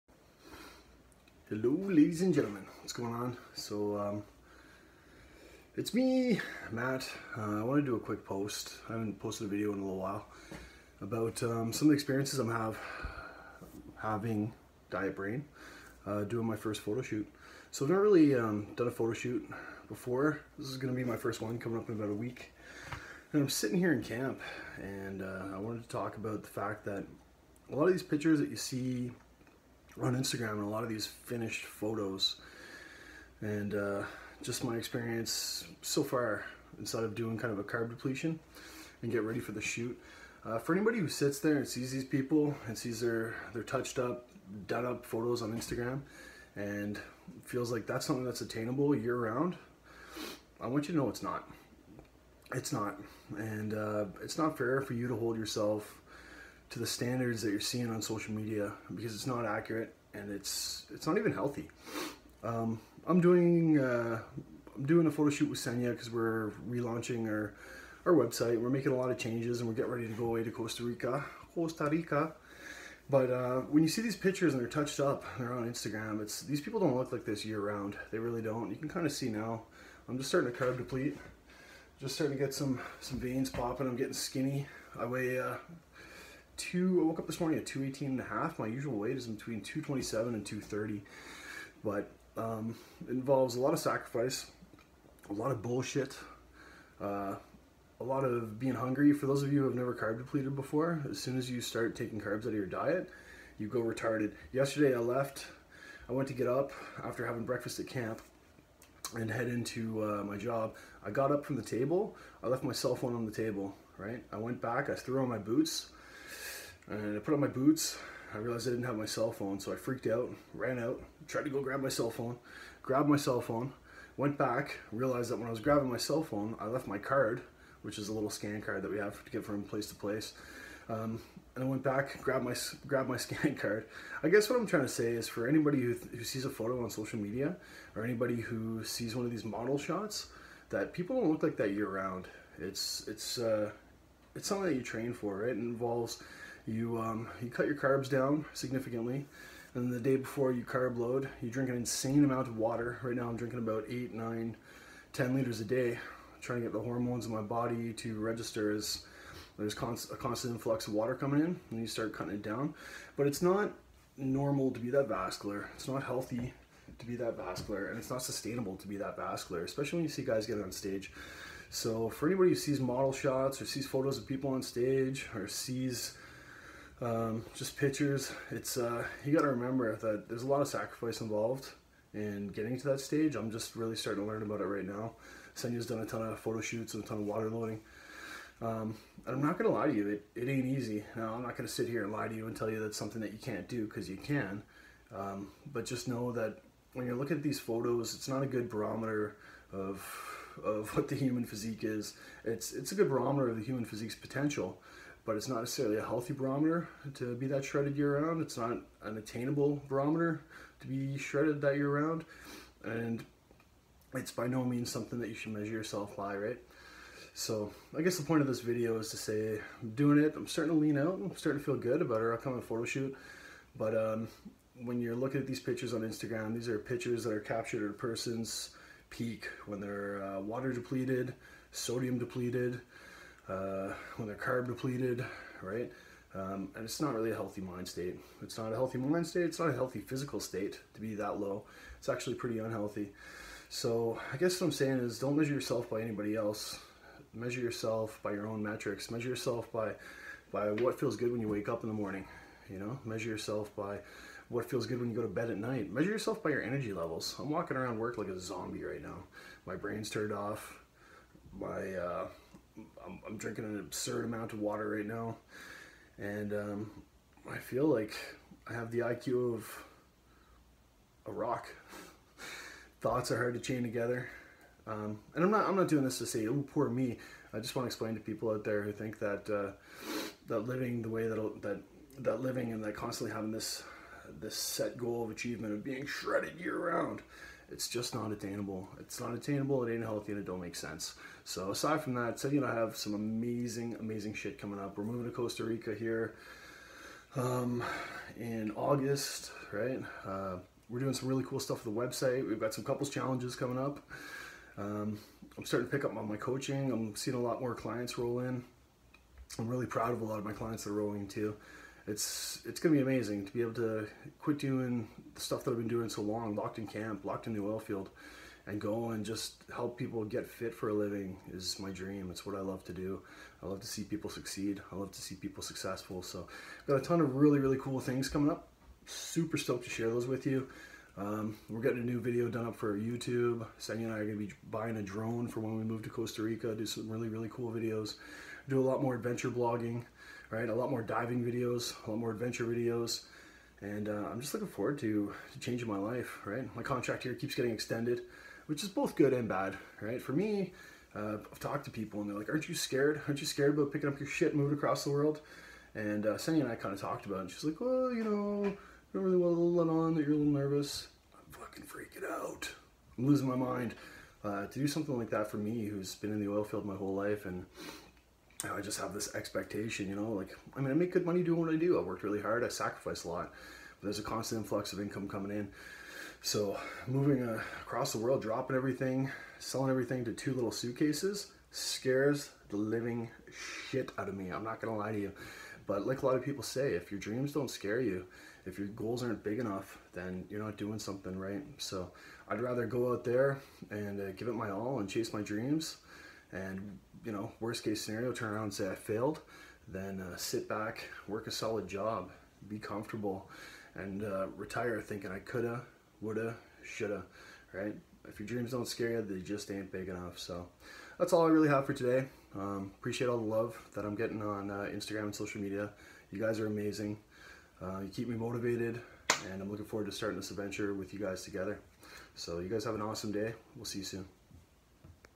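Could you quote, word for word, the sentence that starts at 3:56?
Um, and it's not really a healthy mind state.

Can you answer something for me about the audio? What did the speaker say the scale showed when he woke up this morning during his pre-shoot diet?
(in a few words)
218 and a half.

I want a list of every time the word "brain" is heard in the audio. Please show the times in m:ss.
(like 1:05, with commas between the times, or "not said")
0:15, 4:19.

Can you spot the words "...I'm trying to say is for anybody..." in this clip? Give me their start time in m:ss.
2:14.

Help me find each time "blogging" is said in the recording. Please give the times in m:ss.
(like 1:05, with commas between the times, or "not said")
5:39.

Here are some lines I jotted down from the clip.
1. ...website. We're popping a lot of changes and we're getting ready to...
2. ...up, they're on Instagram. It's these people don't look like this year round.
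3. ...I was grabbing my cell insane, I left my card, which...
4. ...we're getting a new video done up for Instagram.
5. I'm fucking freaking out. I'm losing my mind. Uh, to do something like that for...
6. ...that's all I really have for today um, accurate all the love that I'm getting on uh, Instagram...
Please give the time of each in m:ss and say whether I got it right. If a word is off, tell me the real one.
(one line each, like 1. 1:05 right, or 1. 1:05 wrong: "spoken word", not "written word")
1. 1:08 wrong: "making", not "popping"
2. 1:15 right
3. 2:05 wrong: "phone", not "insane"
4. 5:31 wrong: "YouTube", not "Instagram"
5. 6:01 right
6. 6:51 wrong: "appreciate", not "accurate".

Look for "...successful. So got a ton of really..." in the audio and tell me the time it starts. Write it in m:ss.
5:25.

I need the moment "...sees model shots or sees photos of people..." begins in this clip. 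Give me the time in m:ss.
2:52.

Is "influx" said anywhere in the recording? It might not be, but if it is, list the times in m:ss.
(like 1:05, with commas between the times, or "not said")
2:40, 6:14.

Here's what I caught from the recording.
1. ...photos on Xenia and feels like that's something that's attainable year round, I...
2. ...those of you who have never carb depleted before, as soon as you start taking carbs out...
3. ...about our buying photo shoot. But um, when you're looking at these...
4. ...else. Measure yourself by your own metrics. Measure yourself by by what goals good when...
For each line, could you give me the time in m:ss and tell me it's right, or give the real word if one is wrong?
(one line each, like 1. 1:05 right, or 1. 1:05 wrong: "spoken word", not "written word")
1. 0:45 wrong: "Instagram", not "Xenia"
2. 1:39 right
3. 3:42 wrong: "upcoming", not "buying"
4. 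4:06 wrong: "feels", not "goals".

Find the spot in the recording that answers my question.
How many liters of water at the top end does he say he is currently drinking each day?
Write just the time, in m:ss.
2:35.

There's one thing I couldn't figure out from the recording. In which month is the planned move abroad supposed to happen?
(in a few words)
August.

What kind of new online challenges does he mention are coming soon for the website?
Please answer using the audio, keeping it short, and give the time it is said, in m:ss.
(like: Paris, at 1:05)
couples challenges, at 5:02.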